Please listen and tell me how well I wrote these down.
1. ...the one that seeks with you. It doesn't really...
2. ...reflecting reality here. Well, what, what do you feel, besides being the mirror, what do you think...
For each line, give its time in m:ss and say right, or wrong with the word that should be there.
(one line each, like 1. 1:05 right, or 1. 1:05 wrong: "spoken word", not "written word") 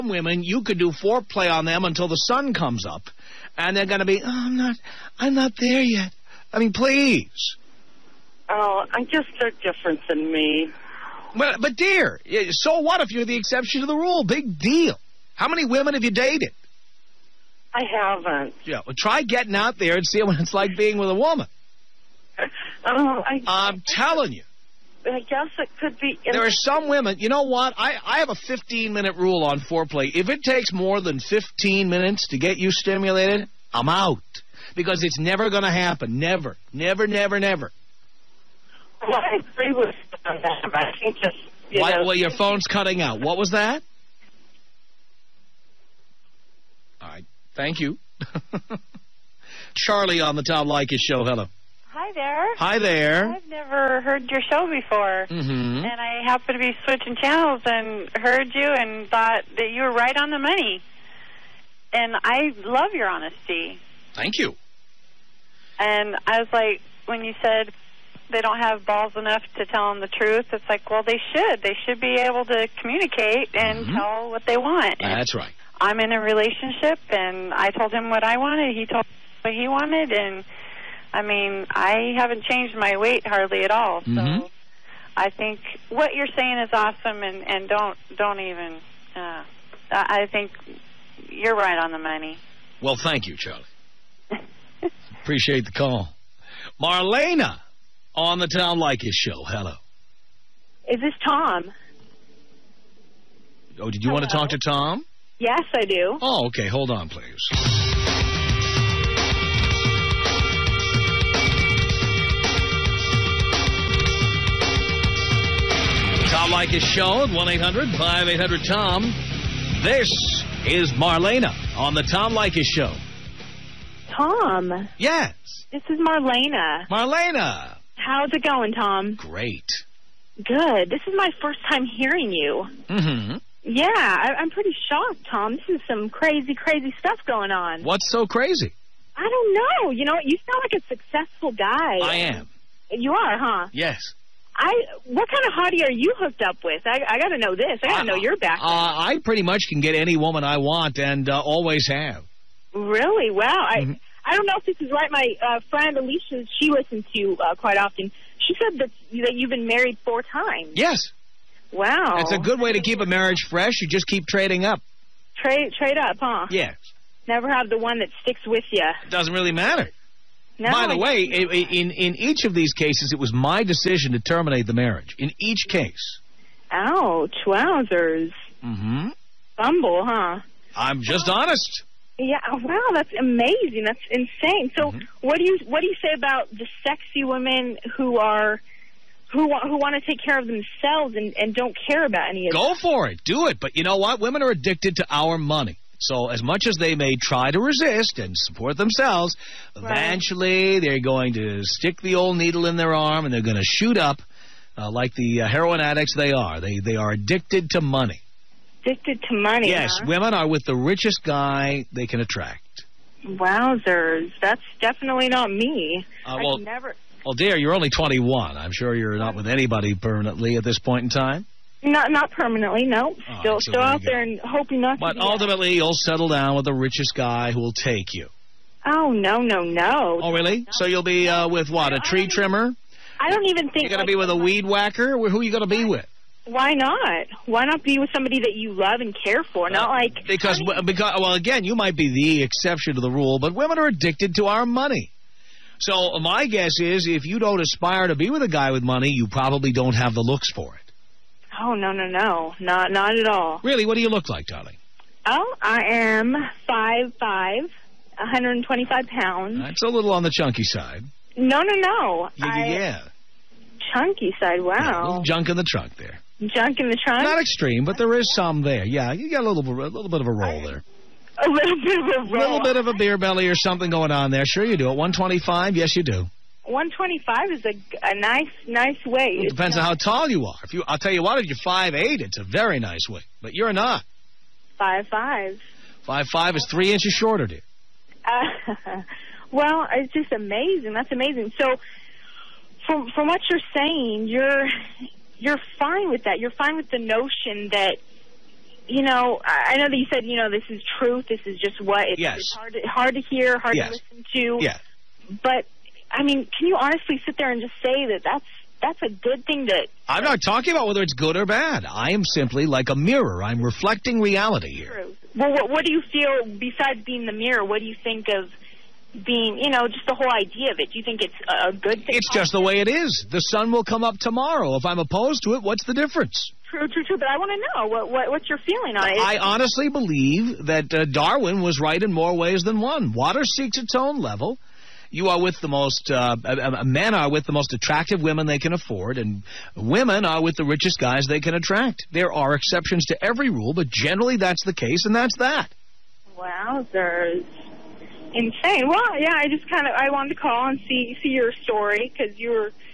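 1. 2:47 wrong: "sticks", not "seeks"
2. 5:13 right.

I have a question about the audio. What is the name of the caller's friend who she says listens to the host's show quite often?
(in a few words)
Alicia.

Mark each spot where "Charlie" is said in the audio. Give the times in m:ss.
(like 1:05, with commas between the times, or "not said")
0:49, 1:33.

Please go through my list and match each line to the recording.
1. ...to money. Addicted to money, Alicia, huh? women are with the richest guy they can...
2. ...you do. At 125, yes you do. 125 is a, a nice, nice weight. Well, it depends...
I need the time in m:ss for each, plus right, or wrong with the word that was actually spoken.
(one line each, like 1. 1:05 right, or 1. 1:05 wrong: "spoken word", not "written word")
1. 3:27 wrong: "Yes", not "Alicia"
2. 4:34 right.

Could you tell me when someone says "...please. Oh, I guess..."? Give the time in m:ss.
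0:06.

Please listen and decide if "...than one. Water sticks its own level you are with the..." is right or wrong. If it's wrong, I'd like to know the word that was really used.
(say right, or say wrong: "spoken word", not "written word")
wrong: "seeks", not "sticks".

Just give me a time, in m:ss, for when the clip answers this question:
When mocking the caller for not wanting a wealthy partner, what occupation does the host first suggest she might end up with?
3:51.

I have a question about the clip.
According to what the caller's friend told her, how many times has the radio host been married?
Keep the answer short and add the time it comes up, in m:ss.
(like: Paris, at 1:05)
4 times, at 2:40.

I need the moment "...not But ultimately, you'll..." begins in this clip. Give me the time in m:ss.
3:44.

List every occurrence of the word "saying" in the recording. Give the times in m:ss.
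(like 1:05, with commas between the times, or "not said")
1:26, 4:53.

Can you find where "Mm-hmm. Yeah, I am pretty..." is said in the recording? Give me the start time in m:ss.
2:12.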